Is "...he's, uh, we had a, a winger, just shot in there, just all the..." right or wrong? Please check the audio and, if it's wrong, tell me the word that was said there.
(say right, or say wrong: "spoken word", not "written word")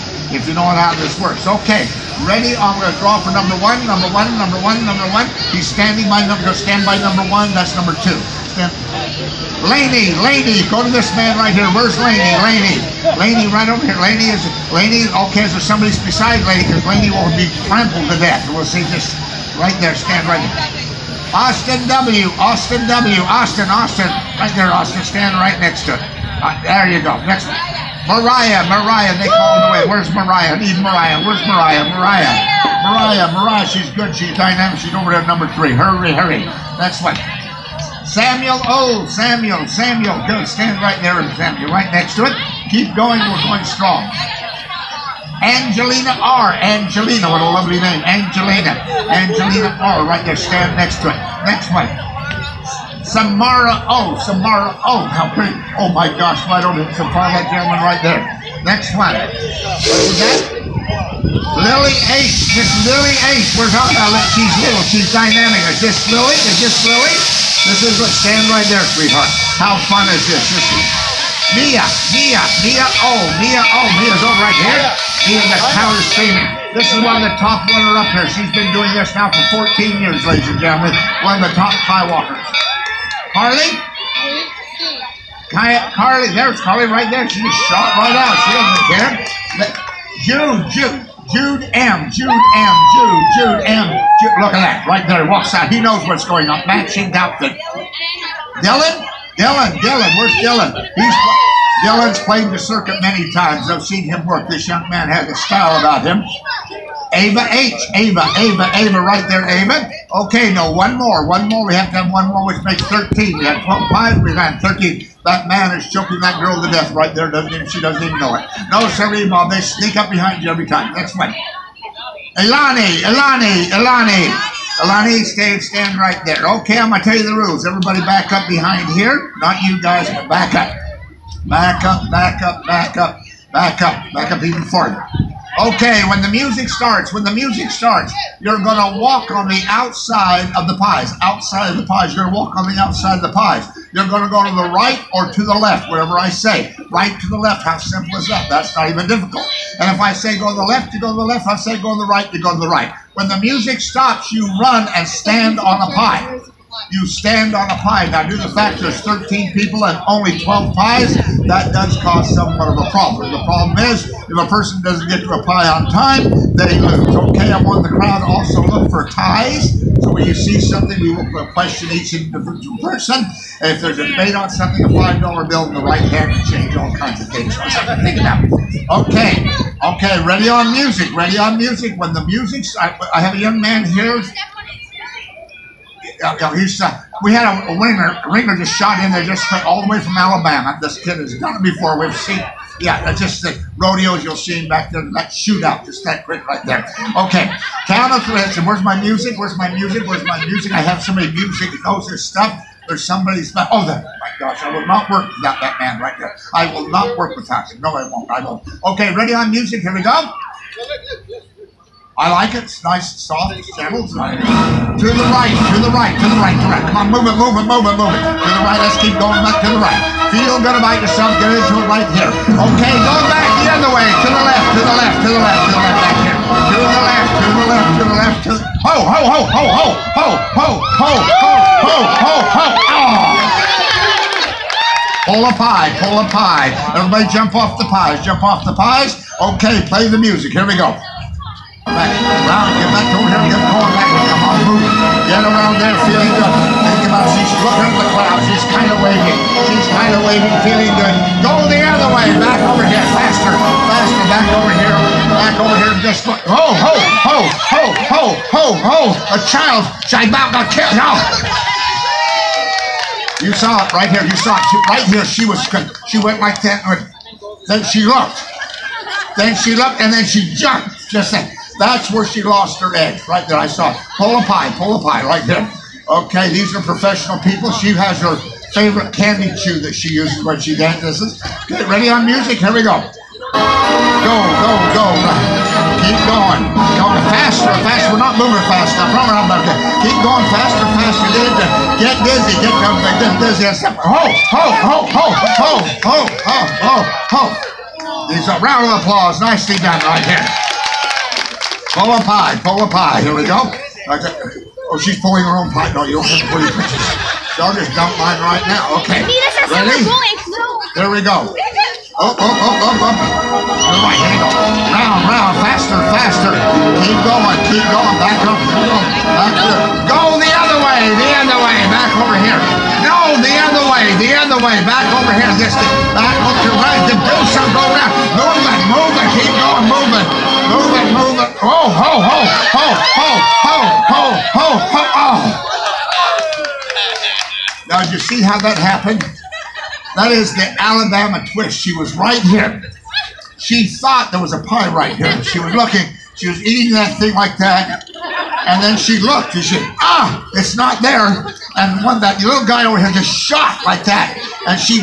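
right.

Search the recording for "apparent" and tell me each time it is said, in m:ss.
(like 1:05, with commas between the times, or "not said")
not said.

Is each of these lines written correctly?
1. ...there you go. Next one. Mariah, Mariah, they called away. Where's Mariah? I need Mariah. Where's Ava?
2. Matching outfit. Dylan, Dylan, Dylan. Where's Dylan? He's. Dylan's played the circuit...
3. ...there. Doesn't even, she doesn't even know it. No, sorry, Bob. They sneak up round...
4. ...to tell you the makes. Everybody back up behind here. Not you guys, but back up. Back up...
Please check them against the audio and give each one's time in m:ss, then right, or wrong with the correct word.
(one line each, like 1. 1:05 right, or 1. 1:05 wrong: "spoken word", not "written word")
1. 0:26 wrong: "Mariah", not "Ava"
2. 1:36 right
3. 1:57 wrong: "behind", not "round"
4. 2:07 wrong: "rules", not "makes".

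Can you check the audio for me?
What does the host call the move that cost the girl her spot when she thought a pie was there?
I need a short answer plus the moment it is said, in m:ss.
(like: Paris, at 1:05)
the Alabama twist, at 5:40.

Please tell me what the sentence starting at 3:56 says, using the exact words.
Everybody jump off the pies, jump off the pies.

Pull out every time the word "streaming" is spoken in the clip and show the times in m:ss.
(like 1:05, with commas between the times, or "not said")
1:16.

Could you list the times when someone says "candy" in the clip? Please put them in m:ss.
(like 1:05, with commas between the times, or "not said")
4:39.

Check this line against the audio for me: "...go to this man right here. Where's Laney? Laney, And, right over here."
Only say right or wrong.
wrong.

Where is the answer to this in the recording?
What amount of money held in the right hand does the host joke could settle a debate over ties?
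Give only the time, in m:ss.
2:54.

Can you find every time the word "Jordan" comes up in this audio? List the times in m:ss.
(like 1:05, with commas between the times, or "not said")
not said.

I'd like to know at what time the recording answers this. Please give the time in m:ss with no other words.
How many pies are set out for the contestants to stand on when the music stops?
2:40.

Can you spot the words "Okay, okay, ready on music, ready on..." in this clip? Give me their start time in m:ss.
2:59.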